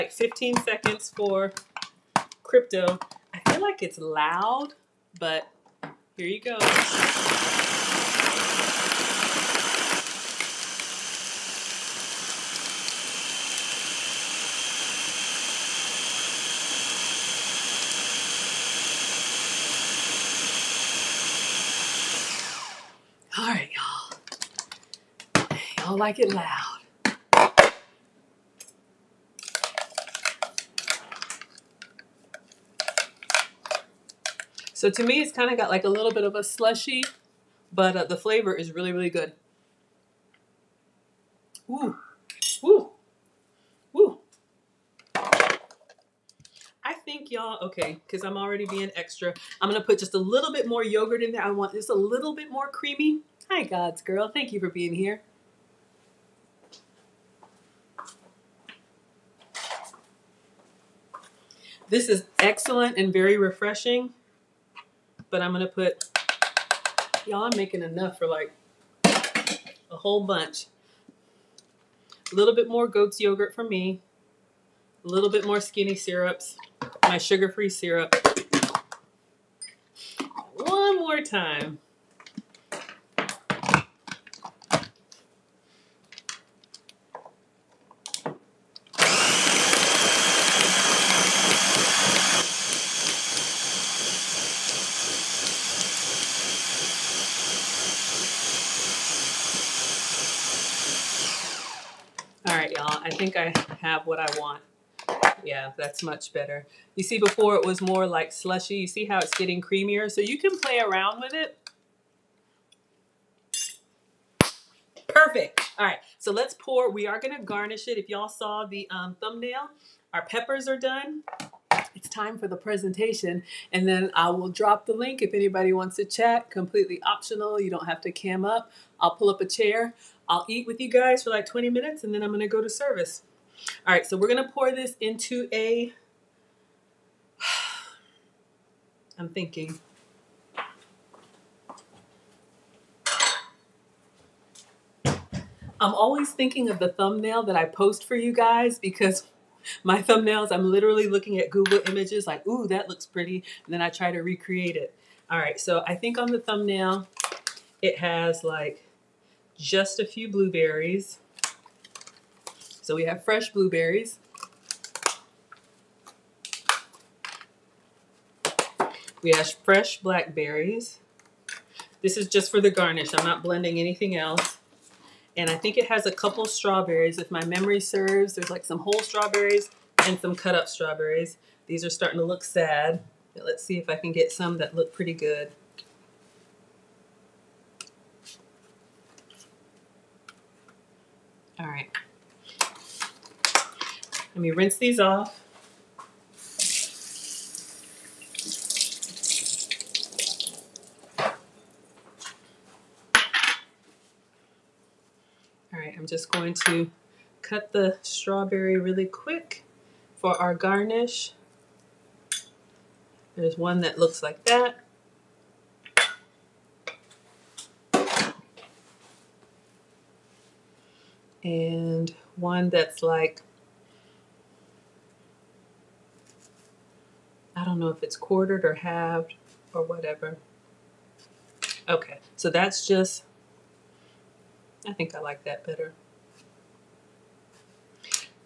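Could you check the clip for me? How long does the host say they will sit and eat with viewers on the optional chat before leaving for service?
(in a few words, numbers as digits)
20 minutes.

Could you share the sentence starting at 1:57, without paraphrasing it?
If y'all saw the um, thumbnail, our peppers are done.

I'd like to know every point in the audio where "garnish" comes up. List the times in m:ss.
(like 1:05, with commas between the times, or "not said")
1:57, 2:52, 3:30.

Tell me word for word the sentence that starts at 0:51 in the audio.
I want just a little bit more creamy.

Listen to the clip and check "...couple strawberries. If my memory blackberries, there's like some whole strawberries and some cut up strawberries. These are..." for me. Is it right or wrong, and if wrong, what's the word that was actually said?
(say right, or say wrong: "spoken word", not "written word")
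wrong: "serves", not "blackberries".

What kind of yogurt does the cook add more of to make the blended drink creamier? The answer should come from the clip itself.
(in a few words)
goat's yogurt.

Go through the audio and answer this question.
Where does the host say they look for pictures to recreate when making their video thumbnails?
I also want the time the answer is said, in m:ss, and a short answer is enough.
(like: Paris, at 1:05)
Google Images, at 2:31.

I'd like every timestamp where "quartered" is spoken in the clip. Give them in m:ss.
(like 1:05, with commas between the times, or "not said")
3:48.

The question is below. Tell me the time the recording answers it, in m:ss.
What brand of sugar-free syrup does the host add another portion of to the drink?
1:15.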